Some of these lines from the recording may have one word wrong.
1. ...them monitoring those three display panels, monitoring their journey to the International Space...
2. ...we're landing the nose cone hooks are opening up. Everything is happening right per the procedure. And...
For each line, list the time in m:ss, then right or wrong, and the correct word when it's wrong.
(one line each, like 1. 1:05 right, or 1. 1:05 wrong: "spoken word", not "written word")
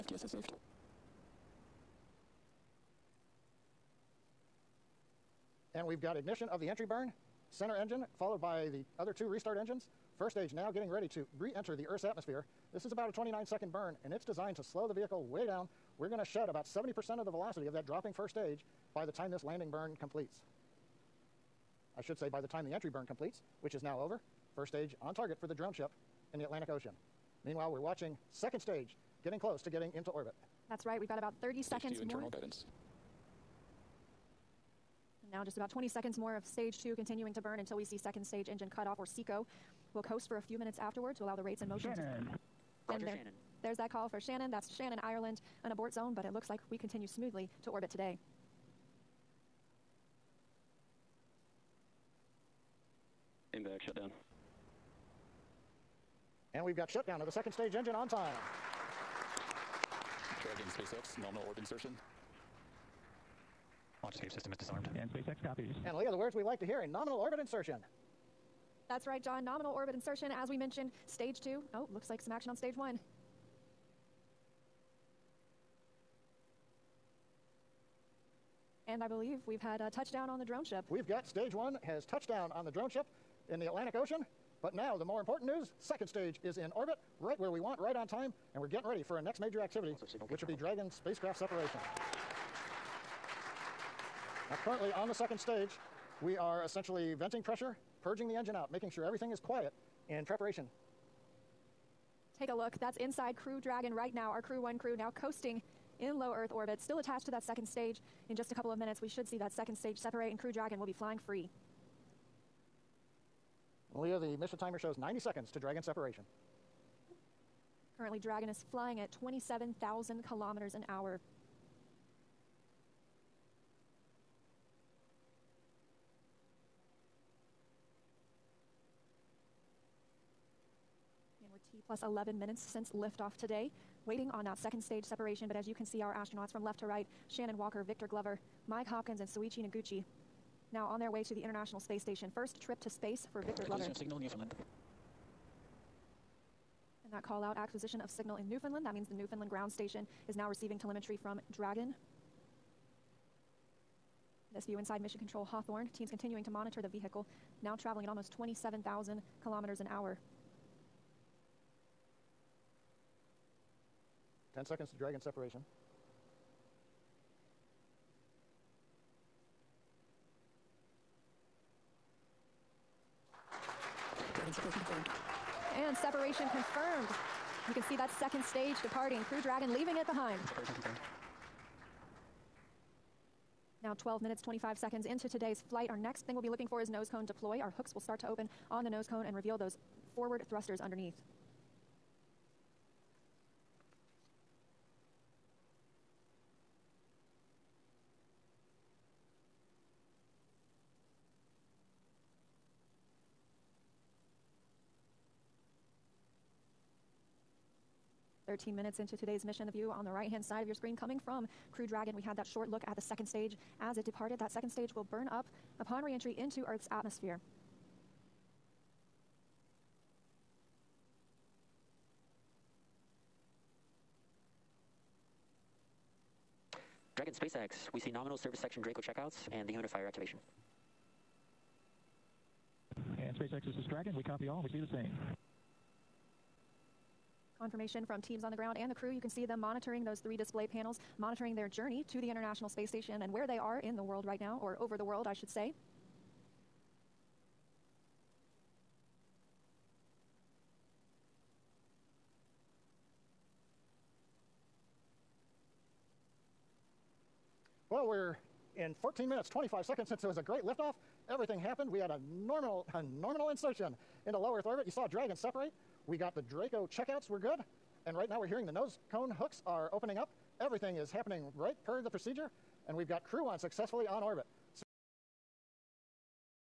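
1. 3:59 right
2. 4:28 wrong: "hearing", not "landing".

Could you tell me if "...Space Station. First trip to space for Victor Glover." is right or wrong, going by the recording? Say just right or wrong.
right.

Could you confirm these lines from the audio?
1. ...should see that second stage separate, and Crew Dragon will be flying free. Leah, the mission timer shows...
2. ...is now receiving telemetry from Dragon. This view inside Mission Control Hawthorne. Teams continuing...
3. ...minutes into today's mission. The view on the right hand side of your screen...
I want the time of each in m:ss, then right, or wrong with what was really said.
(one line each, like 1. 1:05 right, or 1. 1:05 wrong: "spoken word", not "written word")
1. 1:49 right
2. 2:30 right
3. 3:28 right.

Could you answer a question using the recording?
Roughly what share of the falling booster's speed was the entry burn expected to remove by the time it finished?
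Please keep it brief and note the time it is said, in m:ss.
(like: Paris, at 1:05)
70%, at 0:16.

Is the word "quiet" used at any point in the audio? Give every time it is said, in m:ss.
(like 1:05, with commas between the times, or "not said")
1:39.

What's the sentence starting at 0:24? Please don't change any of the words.
First stage on target for the drone ship in the Atlantic Ocean.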